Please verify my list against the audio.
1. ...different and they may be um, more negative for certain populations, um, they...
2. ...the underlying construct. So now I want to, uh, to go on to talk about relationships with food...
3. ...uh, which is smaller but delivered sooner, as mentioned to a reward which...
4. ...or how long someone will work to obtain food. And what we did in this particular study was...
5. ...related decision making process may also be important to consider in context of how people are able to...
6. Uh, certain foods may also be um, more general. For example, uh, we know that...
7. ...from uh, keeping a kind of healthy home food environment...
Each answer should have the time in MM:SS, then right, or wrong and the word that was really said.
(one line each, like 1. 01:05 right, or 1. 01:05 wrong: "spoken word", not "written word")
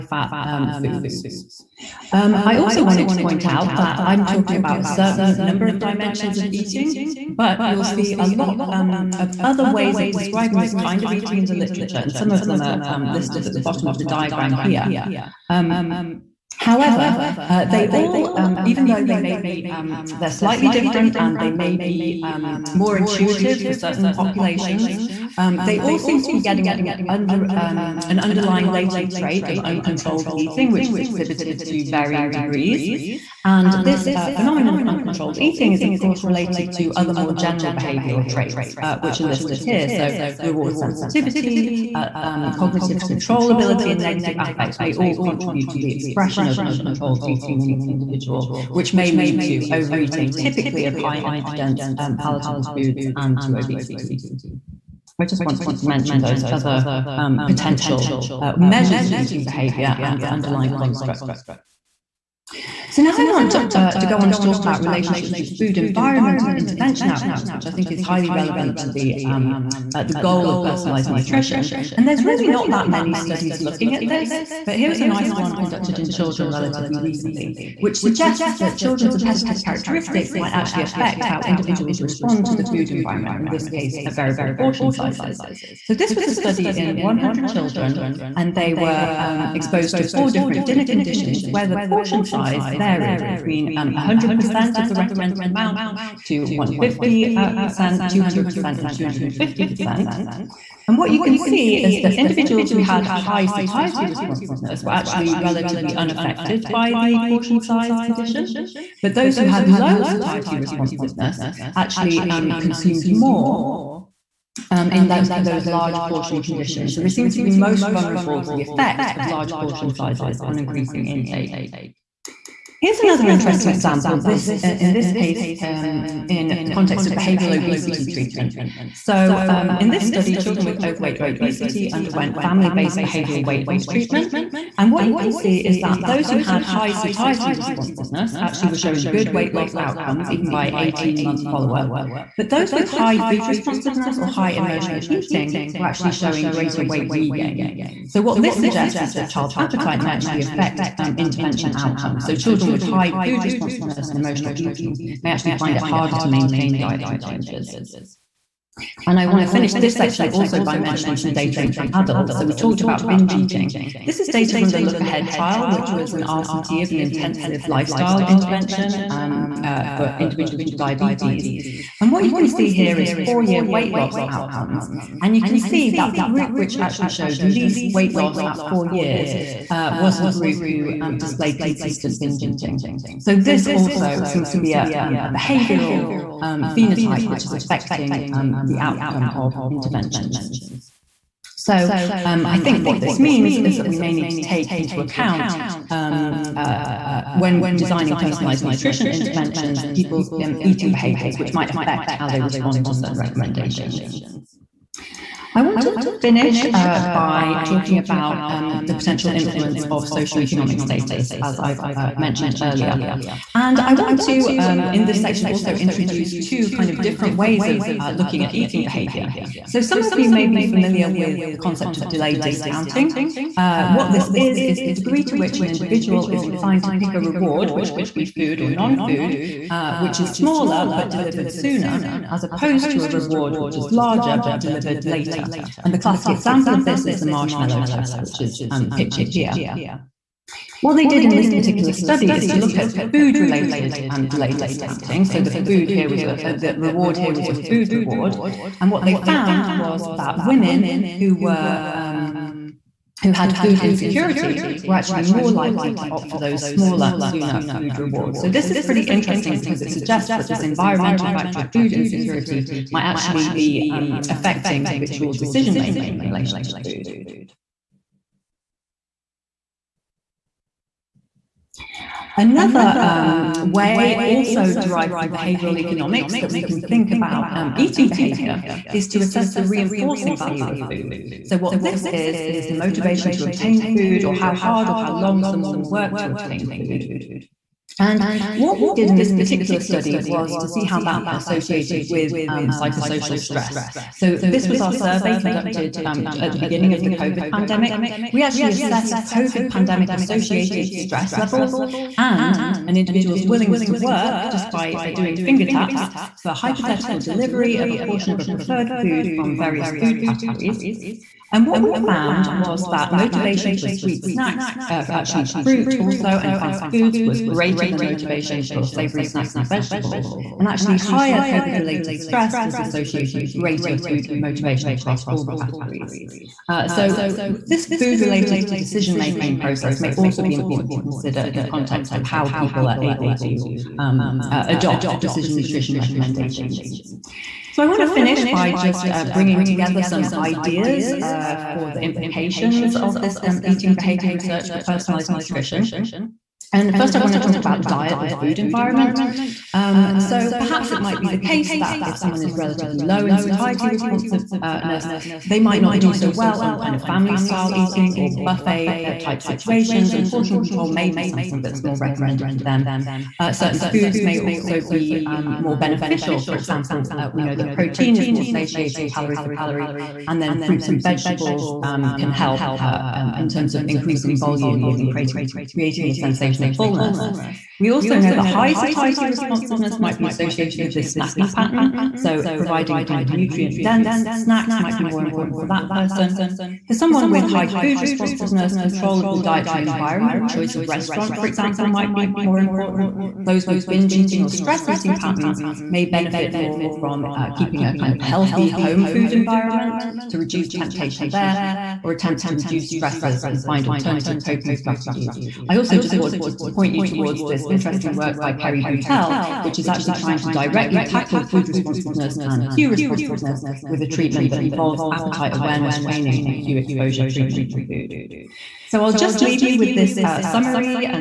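1. 00:20 wrong: "intuitive", not "negative"
2. 01:00 right
3. 03:49 wrong: "opposed", not "mentioned"
4. 04:44 right
5. 05:28 right
6. 06:03 wrong: "beneficial", not "general"
7. 06:36 right.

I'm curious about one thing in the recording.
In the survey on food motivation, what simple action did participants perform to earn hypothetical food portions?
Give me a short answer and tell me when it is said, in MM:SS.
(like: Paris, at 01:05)
Finger taps, at 05:05.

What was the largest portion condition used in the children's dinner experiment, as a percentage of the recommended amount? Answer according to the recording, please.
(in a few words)
250%.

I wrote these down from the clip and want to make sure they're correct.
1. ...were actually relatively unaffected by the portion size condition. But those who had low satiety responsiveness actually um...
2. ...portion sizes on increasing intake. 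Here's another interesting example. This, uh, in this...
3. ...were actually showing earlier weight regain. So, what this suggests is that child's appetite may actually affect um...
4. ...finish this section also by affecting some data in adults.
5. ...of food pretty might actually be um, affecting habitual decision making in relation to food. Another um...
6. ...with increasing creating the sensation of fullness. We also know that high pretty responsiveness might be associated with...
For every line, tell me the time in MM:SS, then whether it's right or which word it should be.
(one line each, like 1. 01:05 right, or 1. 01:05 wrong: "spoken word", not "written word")
1. 01:44 right
2. 01:59 right
3. 02:25 wrong: "greater", not "earlier"
4. 02:39 wrong: "mentioning", not "affecting"
5. 04:21 wrong: "insecurity", not "pretty"
6. 06:14 wrong: "satiety", not "pretty".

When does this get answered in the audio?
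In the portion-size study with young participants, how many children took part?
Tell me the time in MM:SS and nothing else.
01:26.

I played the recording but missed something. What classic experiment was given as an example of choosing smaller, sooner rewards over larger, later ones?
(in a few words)
The marshmallow test.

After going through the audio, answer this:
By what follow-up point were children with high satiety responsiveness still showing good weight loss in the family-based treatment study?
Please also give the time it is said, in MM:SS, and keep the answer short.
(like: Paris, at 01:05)
18 months, at 02:20.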